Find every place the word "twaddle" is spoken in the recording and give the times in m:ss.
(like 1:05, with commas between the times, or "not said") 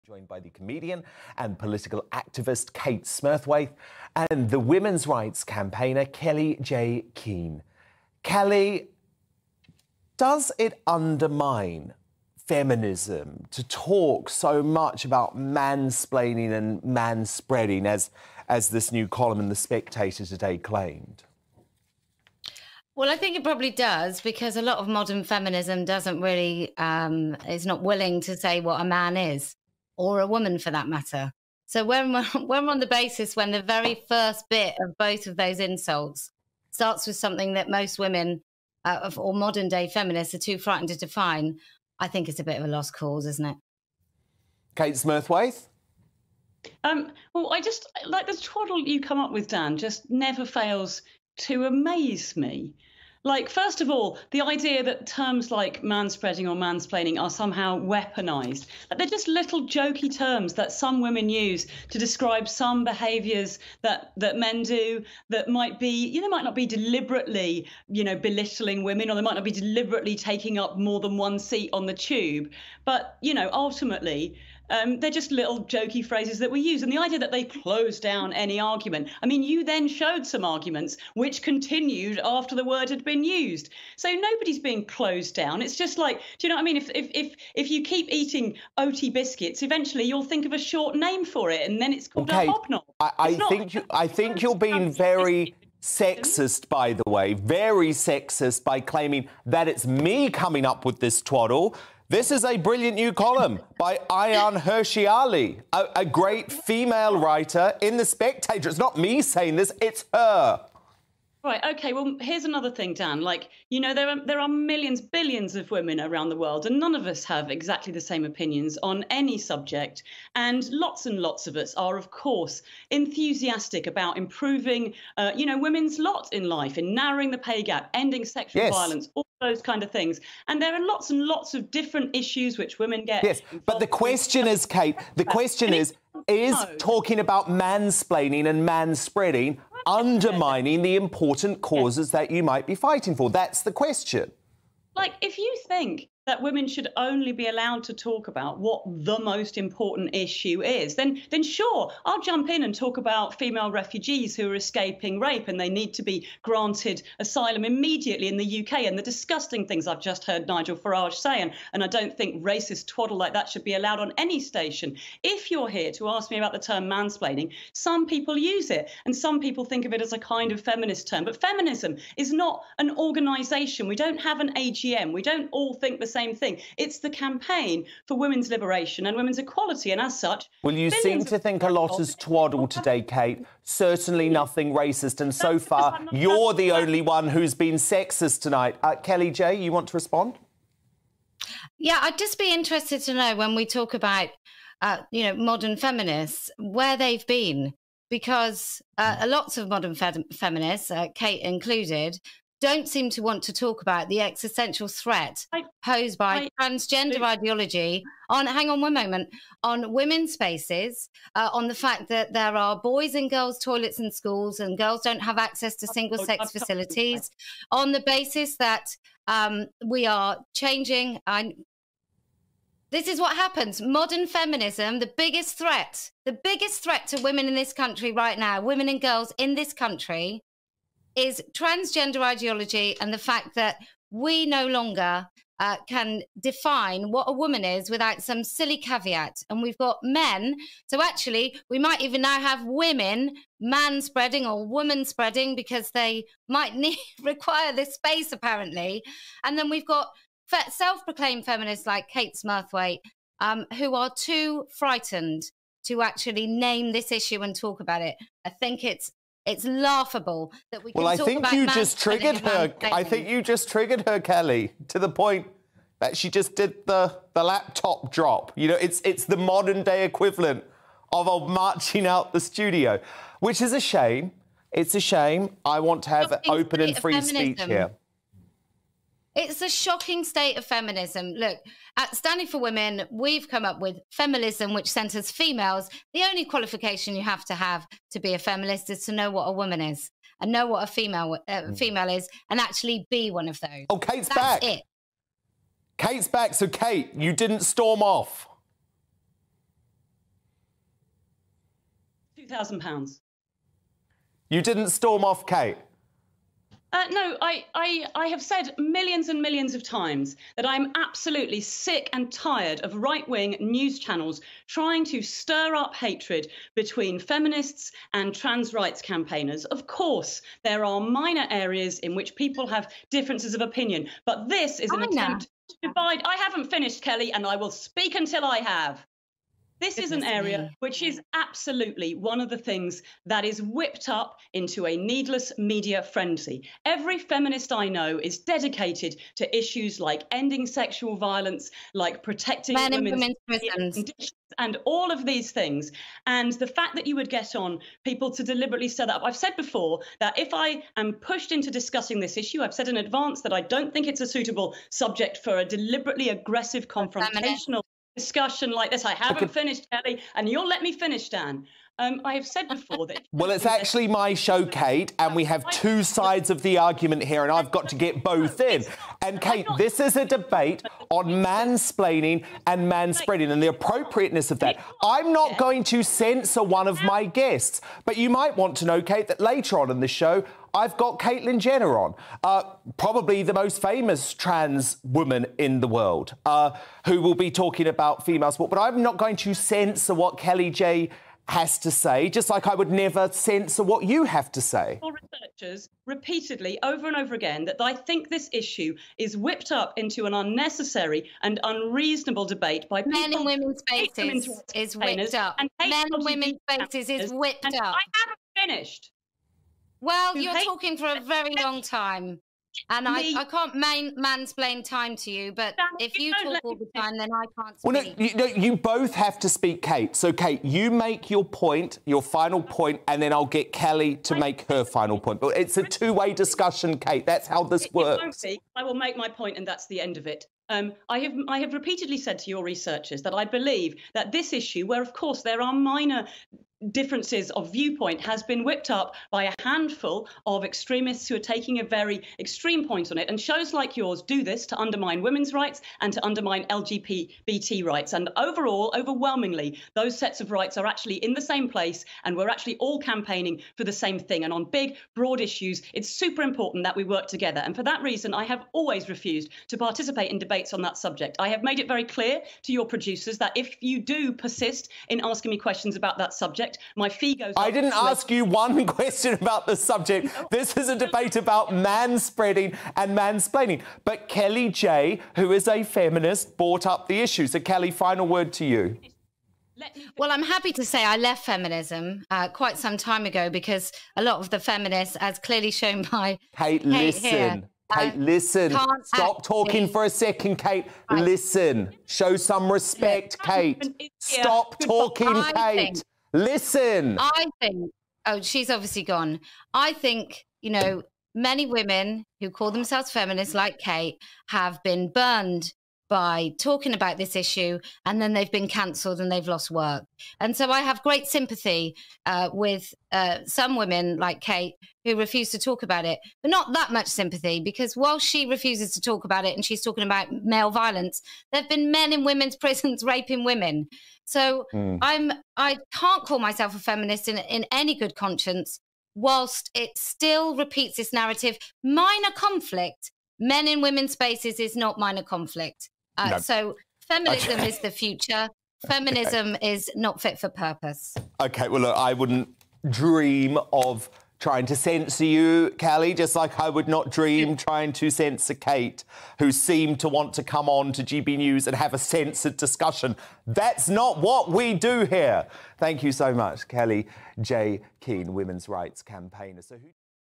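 0:48, 1:41, 2:42, 3:02.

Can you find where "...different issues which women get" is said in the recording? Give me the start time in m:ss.
2:11.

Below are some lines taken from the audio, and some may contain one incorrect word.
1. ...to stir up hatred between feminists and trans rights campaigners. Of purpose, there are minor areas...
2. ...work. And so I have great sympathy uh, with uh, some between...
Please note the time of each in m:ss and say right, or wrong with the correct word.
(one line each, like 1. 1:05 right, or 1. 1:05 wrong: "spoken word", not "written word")
1. 5:15 wrong: "course", not "purpose"
2. 8:29 wrong: "women", not "between".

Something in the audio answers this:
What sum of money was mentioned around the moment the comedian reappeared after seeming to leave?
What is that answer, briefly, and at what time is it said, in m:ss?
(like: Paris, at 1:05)
£2,000, at 5:02.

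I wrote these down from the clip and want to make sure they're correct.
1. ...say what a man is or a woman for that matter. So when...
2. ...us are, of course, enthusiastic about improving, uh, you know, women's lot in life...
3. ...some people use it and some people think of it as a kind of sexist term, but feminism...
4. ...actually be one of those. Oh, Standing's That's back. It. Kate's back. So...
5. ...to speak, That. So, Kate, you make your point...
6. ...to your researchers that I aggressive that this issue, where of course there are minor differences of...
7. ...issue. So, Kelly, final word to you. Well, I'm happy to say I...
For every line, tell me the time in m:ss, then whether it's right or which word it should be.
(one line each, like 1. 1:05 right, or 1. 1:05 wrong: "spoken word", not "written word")
1. 0:28 right
2. 2:01 right
3. 2:47 wrong: "feminist", not "sexist"
4. 4:52 wrong: "Kate", not "Standing"
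5. 6:59 wrong: "Kate", not "That"
6. 7:12 wrong: "believe", not "aggressive"
7. 7:57 right.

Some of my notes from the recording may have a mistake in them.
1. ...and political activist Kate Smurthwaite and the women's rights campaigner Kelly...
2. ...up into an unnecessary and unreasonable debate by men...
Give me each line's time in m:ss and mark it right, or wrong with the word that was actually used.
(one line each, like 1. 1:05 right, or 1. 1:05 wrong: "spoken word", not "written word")
1. 0:01 right
2. 6:39 right.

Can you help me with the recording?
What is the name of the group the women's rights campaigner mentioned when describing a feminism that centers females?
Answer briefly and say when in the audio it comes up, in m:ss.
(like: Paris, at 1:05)
Standing for Women, at 4:42.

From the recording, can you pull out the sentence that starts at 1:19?
I mean, you then showed some arguments which continued after the word had been used.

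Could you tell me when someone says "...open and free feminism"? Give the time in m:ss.
4:36.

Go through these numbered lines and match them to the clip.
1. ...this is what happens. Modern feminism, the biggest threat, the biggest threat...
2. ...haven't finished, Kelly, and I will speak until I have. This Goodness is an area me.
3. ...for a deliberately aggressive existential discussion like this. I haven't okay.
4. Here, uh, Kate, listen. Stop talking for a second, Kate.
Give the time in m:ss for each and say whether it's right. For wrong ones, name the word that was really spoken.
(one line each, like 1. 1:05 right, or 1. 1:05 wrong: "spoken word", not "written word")
1. 3:42 right
2. 5:26 right
3. 5:55 wrong: "confrontational", not "existential"
4. 8:07 right.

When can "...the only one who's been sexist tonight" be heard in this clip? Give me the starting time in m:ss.
3:06.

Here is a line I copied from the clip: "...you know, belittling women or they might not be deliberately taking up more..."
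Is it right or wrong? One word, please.
right.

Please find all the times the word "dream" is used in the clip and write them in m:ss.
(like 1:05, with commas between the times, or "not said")
9:02, 9:07.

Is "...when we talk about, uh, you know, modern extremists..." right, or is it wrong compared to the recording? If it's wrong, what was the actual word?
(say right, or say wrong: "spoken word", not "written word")
wrong: "feminists", not "extremists".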